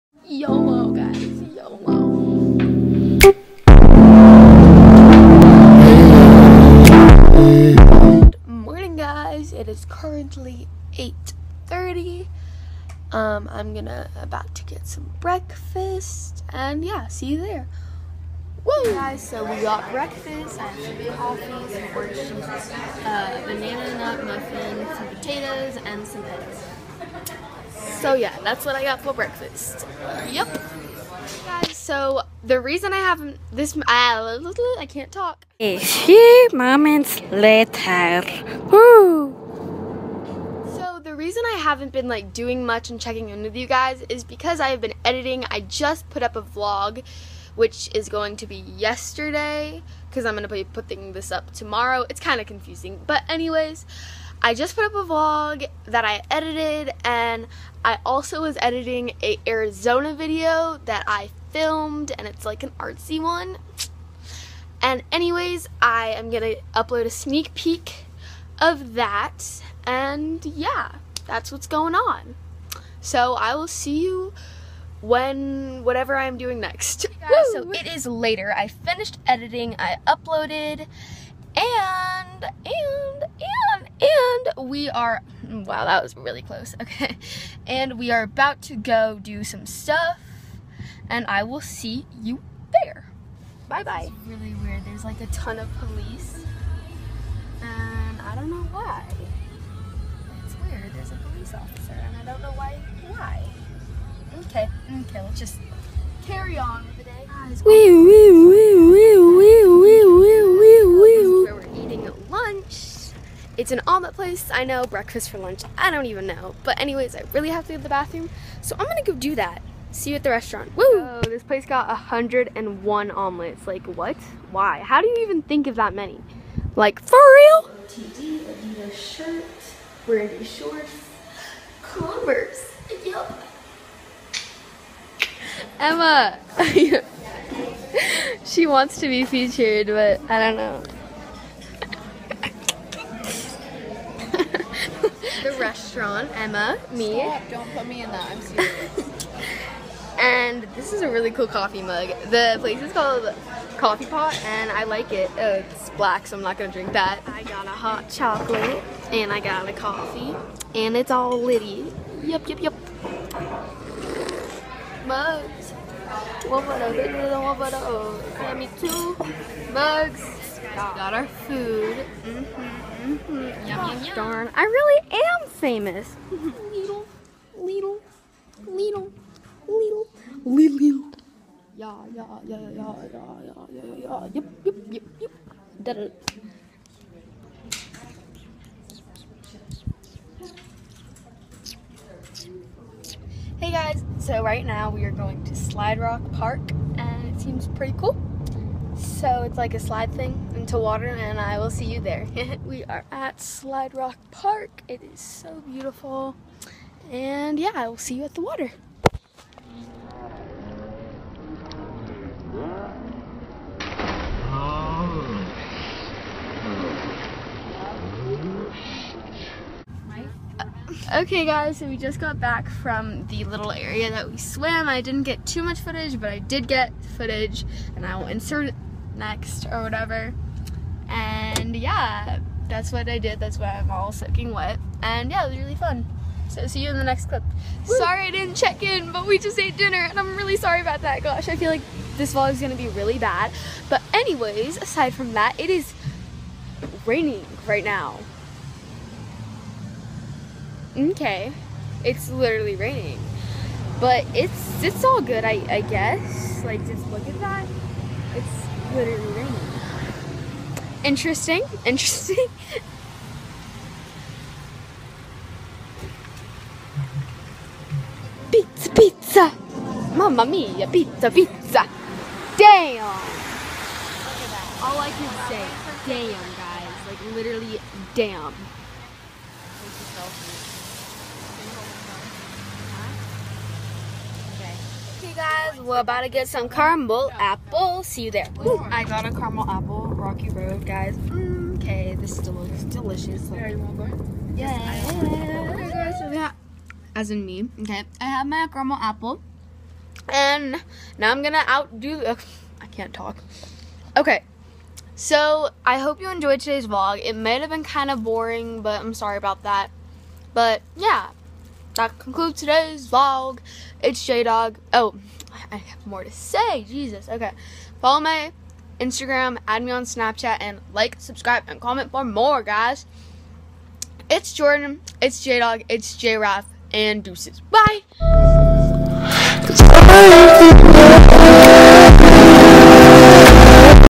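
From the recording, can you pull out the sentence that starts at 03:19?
So it's like a slide thing into water and I will see you there.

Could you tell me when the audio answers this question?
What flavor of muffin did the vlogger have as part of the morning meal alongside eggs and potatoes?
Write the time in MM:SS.
00:23.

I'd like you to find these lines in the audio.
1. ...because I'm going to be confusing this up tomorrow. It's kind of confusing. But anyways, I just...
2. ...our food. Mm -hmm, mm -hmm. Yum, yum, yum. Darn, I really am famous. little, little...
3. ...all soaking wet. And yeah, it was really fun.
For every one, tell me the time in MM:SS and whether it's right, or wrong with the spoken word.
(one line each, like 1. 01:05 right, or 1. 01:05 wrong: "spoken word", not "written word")
1. 00:50 wrong: "putting", not "confusing"
2. 02:51 right
3. 03:53 right.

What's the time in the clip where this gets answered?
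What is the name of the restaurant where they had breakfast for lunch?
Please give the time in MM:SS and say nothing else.
02:33.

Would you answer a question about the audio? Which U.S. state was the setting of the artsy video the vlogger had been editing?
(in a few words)
Arizona.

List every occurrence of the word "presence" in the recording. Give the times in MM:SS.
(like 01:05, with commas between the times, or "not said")
not said.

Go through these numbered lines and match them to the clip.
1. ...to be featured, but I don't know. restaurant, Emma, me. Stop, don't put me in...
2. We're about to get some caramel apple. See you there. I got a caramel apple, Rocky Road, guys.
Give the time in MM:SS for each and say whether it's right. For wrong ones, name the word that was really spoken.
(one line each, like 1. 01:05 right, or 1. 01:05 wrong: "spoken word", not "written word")
1. 02:19 right
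2. 04:45 right.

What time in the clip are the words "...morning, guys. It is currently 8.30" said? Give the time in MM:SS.
00:08.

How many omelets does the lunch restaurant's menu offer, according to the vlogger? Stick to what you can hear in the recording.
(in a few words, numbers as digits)
101.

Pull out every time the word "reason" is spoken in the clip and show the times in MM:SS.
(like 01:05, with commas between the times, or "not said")
00:32, 00:41.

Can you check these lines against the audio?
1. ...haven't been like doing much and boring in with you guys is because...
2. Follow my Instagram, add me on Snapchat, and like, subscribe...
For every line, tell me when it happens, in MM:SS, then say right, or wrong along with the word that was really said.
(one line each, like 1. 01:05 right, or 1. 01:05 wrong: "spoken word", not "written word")
1. 00:41 wrong: "checking", not "boring"
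2. 05:18 right.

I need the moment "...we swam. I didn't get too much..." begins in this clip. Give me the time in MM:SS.
03:44.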